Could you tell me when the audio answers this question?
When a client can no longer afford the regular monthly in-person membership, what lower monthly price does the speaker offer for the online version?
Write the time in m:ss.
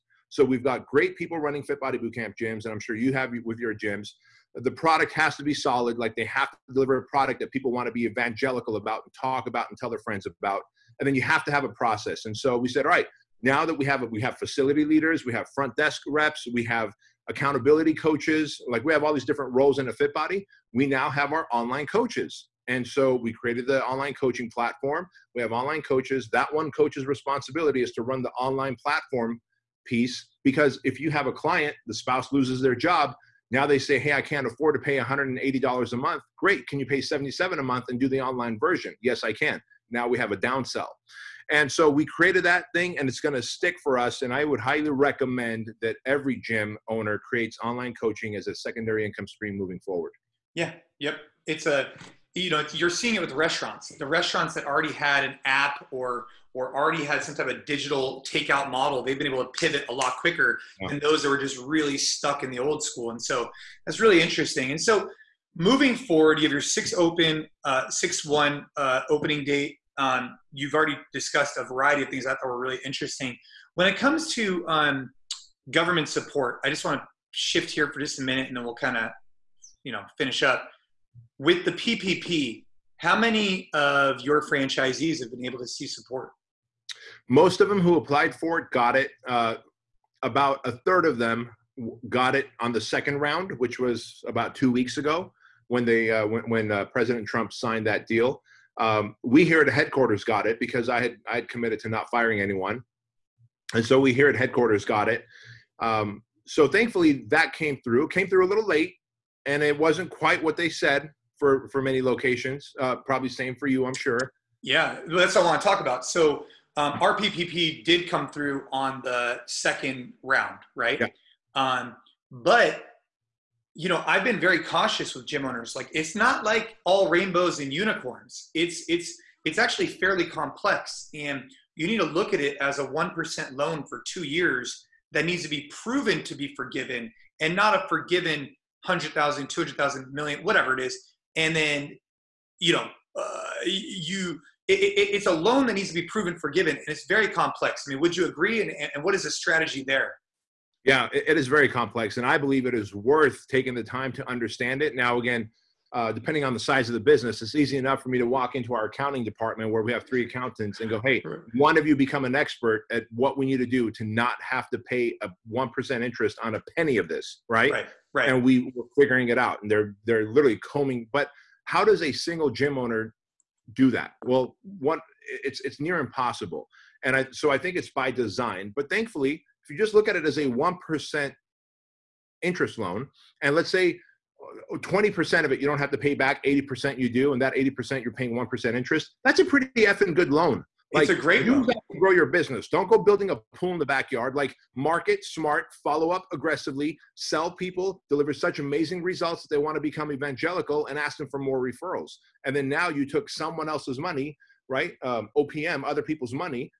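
0:37.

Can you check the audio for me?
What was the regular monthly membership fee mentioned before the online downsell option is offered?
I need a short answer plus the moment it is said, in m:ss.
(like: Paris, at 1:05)
$180, at 0:34.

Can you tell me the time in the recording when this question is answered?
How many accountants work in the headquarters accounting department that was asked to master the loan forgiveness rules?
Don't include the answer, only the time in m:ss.
2:40.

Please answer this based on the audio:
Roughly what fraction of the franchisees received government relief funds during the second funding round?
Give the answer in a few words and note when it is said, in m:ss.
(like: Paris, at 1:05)
a third, at 1:30.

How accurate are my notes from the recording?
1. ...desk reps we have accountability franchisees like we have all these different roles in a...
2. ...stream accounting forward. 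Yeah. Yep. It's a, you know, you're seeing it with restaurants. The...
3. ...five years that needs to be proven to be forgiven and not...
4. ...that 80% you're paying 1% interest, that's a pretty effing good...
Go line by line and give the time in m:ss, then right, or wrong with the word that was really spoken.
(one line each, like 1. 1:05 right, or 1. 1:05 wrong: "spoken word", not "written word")
1. 0:15 wrong: "coaches", not "franchisees"
2. 0:49 wrong: "moving", not "accounting"
3. 2:14 wrong: "two", not "five"
4. 3:07 right.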